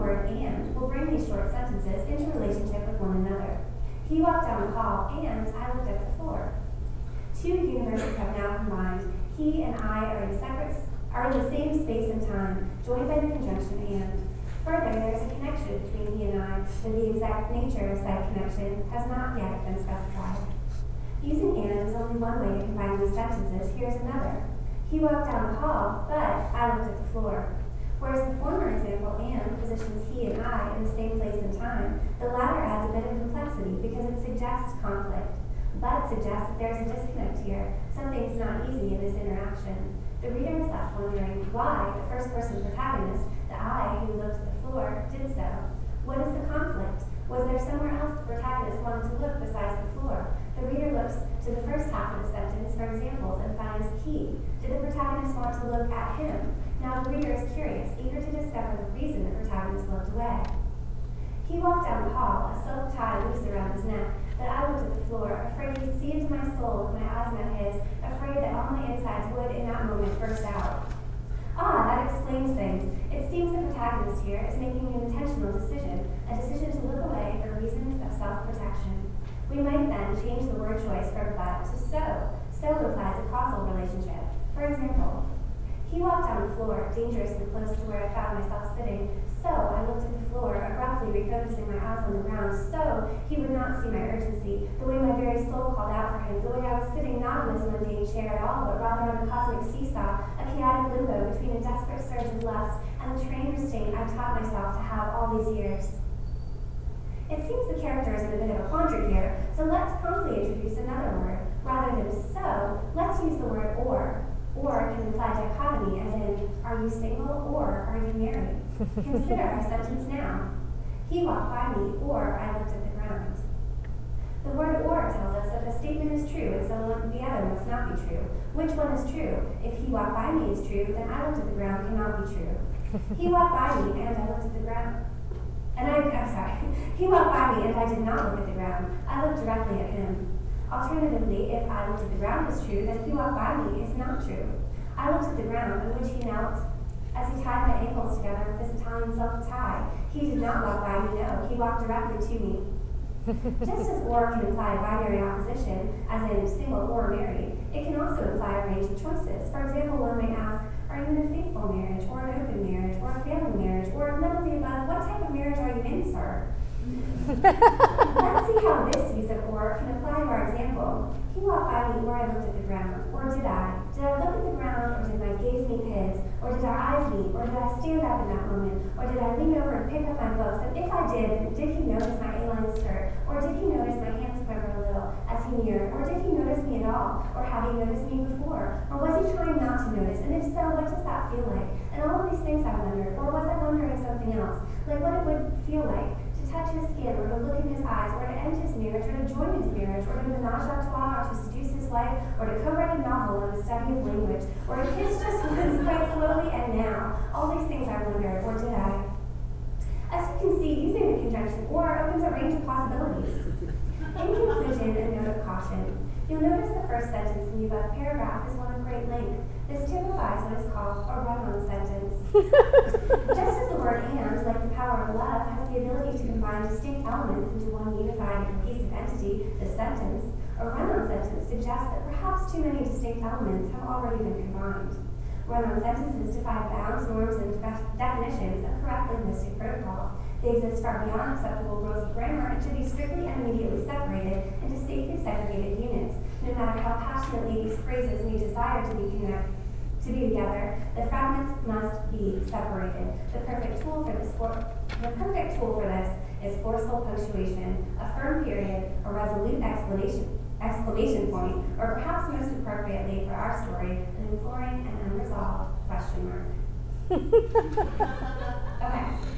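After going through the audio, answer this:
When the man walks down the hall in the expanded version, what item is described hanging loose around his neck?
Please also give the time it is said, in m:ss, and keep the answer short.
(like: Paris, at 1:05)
a silk tie, at 1:02.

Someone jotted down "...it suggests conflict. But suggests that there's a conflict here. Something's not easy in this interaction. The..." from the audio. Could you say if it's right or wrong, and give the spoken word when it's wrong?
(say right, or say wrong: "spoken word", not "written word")
wrong: "disconnect", not "conflict".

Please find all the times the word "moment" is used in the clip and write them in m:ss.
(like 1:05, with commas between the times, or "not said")
1:09, 2:58.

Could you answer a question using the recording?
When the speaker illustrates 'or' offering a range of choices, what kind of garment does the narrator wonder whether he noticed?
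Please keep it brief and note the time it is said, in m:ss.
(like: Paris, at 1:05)
A-line skirt, at 3:02.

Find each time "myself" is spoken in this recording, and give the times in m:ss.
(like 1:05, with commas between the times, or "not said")
1:28, 1:44.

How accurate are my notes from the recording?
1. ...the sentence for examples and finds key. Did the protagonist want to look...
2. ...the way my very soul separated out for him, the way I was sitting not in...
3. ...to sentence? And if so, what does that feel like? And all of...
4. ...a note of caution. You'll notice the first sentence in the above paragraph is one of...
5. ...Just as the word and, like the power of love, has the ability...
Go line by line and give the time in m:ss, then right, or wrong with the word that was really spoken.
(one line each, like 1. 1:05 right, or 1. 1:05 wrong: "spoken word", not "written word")
1. 0:52 right
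2. 1:34 wrong: "called", not "separated"
3. 3:09 wrong: "notice", not "sentence"
4. 3:34 right
5. 3:43 right.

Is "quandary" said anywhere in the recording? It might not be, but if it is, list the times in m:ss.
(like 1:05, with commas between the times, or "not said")
1:48.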